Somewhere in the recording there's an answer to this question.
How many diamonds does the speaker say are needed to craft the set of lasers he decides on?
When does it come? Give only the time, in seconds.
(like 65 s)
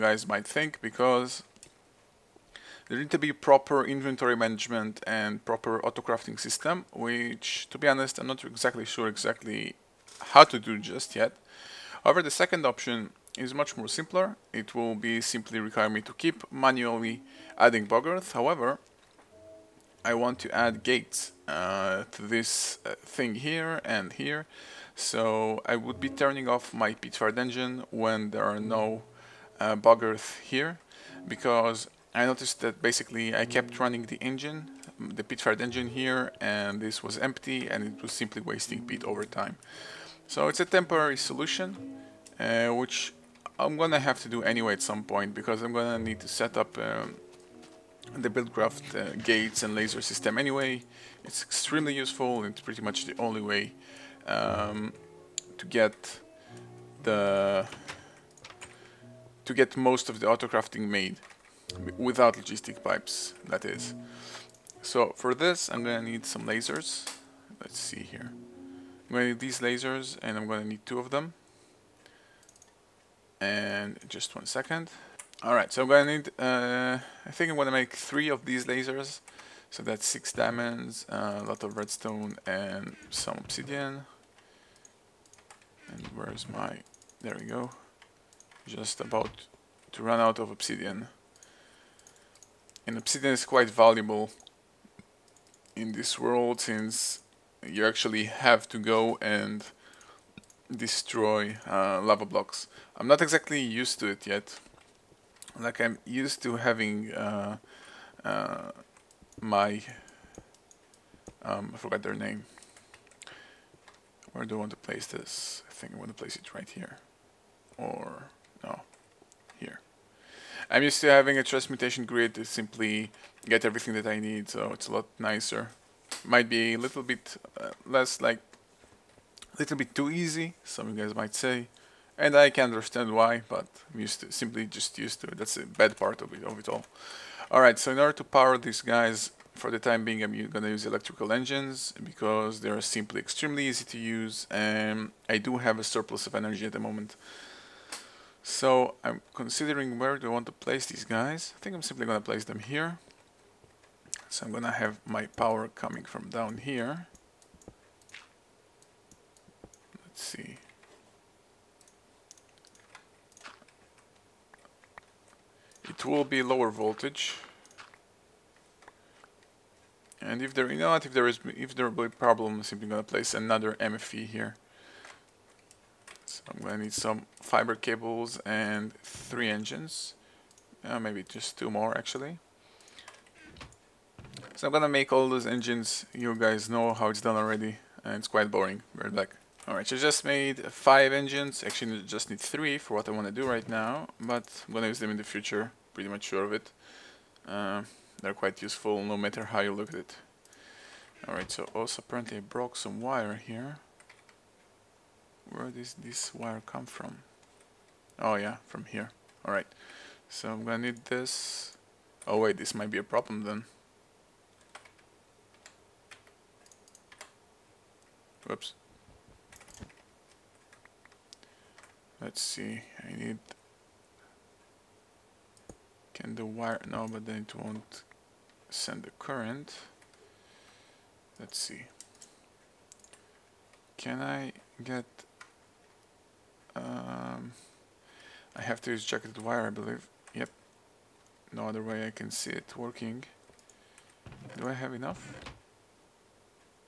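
80 s.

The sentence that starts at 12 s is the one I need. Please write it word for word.
However, the second option is much more simpler.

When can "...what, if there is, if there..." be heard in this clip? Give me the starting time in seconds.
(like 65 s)
170 s.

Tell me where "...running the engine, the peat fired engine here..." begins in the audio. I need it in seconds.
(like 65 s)
33 s.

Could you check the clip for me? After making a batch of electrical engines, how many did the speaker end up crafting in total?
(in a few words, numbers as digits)
5.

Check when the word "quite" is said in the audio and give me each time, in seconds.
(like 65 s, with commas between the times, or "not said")
93 s, 188 s, 198 s.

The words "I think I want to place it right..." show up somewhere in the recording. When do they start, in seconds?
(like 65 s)
115 s.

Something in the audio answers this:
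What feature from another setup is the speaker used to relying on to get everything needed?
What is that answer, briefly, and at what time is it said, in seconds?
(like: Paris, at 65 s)
transmutation grid, at 121 s.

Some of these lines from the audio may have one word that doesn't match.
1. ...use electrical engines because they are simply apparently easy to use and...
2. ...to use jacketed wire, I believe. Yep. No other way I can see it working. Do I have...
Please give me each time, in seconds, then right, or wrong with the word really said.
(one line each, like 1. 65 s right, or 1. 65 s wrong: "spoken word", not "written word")
1. 140 s wrong: "extremely", not "apparently"
2. 238 s right.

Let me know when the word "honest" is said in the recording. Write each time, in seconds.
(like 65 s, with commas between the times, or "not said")
7 s.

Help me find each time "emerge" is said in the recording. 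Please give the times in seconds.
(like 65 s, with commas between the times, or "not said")
not said.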